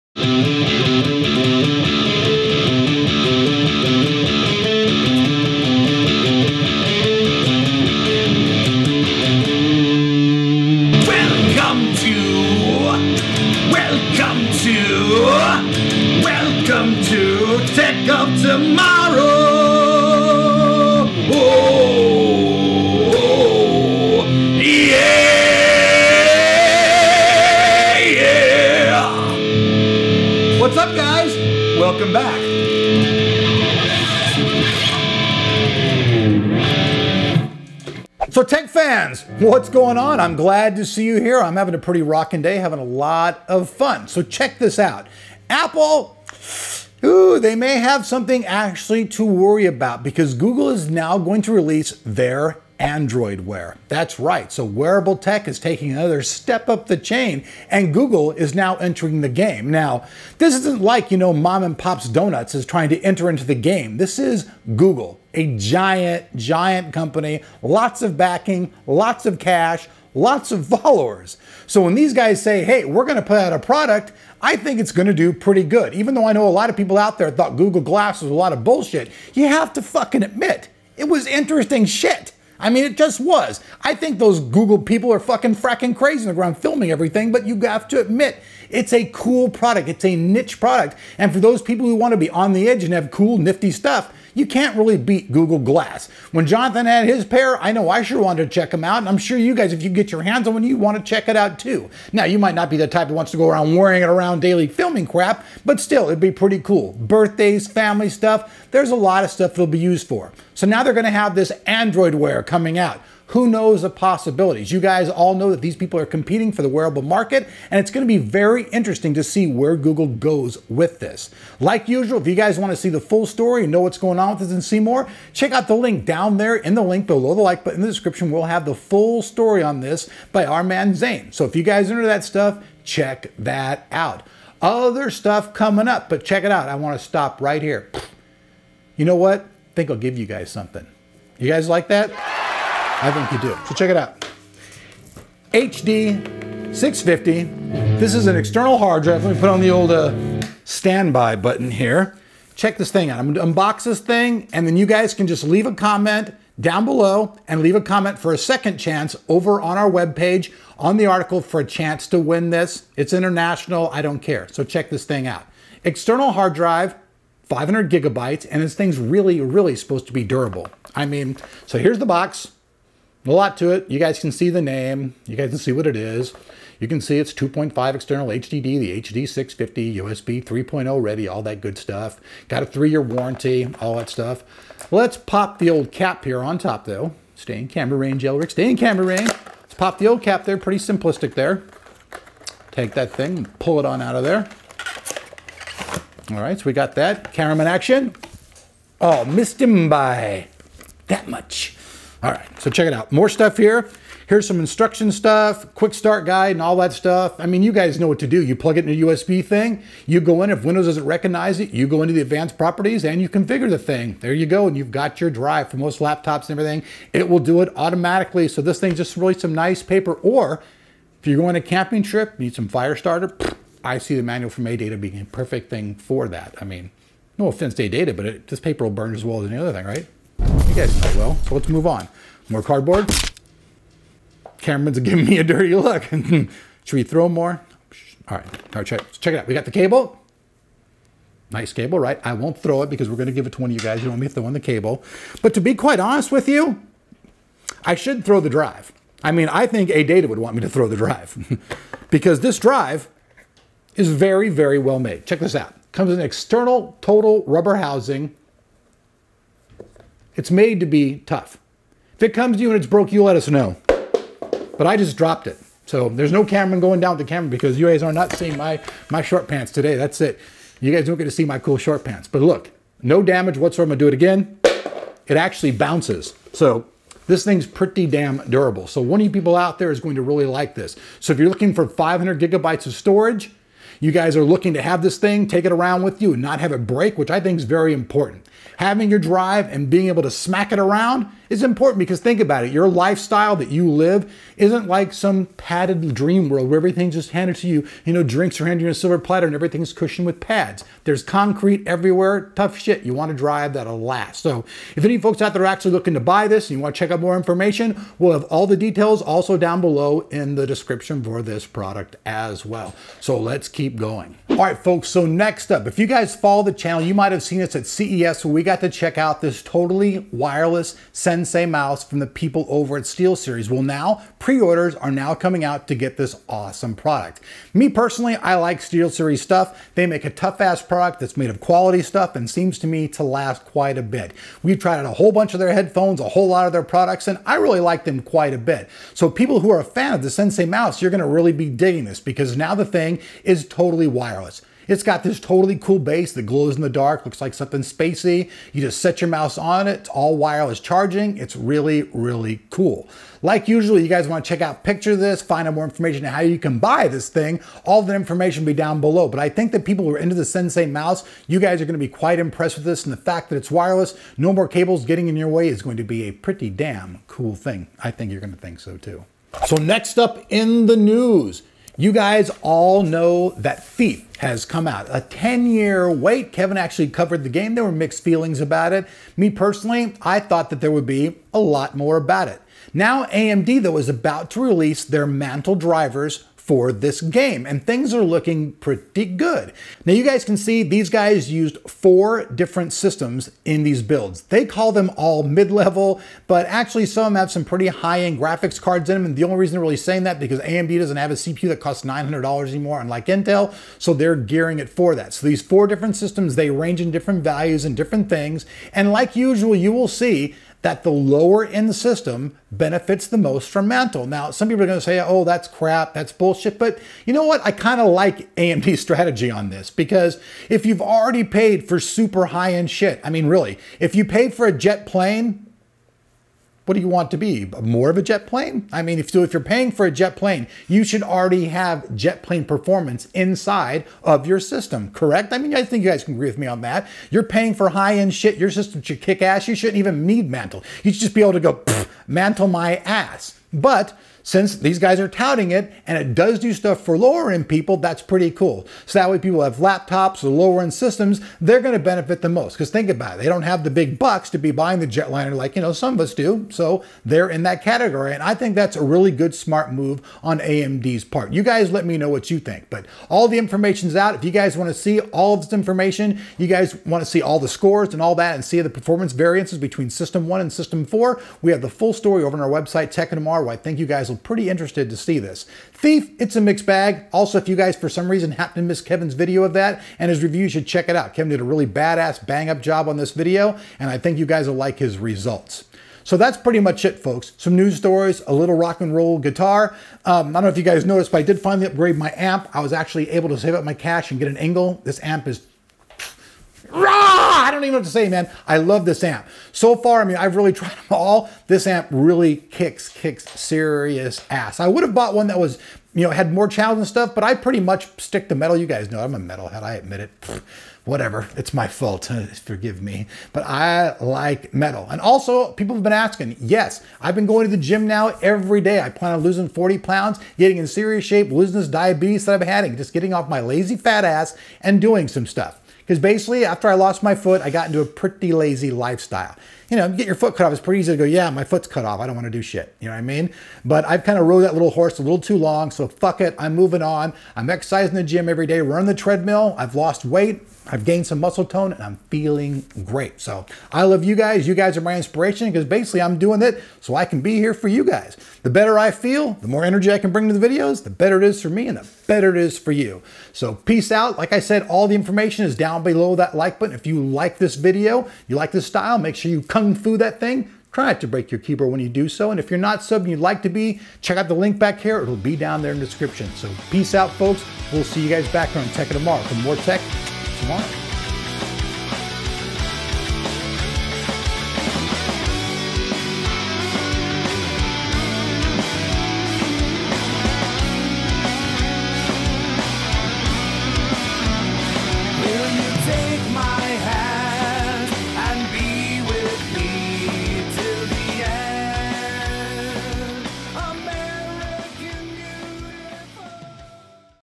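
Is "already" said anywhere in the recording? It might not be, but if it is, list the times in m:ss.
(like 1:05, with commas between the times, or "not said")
7:01, 7:11.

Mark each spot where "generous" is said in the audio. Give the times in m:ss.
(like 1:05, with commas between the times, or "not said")
not said.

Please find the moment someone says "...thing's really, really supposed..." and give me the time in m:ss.
2:48.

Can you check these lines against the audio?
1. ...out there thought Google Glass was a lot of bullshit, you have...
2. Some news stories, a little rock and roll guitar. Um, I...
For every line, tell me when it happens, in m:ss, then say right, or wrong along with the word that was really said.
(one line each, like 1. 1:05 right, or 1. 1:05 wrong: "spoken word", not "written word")
1. 1:16 right
2. 8:07 right.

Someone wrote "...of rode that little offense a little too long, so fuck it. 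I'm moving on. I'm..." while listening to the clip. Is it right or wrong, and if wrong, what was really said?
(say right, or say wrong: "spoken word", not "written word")
wrong: "horse", not "offense".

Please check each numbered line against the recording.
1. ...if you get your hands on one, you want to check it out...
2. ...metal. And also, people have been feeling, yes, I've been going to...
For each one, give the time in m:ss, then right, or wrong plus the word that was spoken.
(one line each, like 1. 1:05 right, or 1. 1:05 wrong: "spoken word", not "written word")
1. 1:39 right
2. 8:34 wrong: "asking", not "feeling".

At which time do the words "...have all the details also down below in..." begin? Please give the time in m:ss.
5:08.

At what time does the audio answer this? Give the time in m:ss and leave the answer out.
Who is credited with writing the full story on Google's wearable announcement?
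2:10.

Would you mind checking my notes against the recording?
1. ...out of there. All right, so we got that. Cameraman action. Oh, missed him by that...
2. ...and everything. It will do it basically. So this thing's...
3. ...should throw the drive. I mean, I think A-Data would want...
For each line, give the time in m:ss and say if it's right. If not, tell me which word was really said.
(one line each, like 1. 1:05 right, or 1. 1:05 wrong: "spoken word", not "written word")
1. 3:14 right
2. 3:36 wrong: "automatically", not "basically"
3. 4:07 right.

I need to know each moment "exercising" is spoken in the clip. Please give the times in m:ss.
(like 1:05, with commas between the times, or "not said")
8:57.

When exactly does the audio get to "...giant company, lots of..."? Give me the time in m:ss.
1:06.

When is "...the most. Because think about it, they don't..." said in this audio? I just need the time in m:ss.
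7:32.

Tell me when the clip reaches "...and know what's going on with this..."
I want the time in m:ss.
2:03.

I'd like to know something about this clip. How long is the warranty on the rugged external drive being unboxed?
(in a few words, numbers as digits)
three-year.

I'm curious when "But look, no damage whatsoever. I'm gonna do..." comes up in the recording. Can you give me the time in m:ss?
4:32.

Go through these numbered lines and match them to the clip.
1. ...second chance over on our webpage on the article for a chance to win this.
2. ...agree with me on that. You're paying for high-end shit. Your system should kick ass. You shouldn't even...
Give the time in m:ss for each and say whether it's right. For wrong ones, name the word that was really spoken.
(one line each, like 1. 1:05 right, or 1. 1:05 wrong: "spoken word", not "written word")
1. 2:38 right
2. 7:16 right.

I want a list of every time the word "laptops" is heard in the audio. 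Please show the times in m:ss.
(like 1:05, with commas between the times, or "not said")
3:35, 7:29.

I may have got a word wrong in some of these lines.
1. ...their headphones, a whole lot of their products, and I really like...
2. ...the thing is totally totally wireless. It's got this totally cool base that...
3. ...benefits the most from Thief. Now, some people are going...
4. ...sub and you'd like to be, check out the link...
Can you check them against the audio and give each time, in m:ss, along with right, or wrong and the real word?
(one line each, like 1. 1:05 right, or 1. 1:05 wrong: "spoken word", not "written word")
1. 5:35 right
2. 5:42 right
3. 6:52 wrong: "Mantle", not "Thief"
4. 9:23 right.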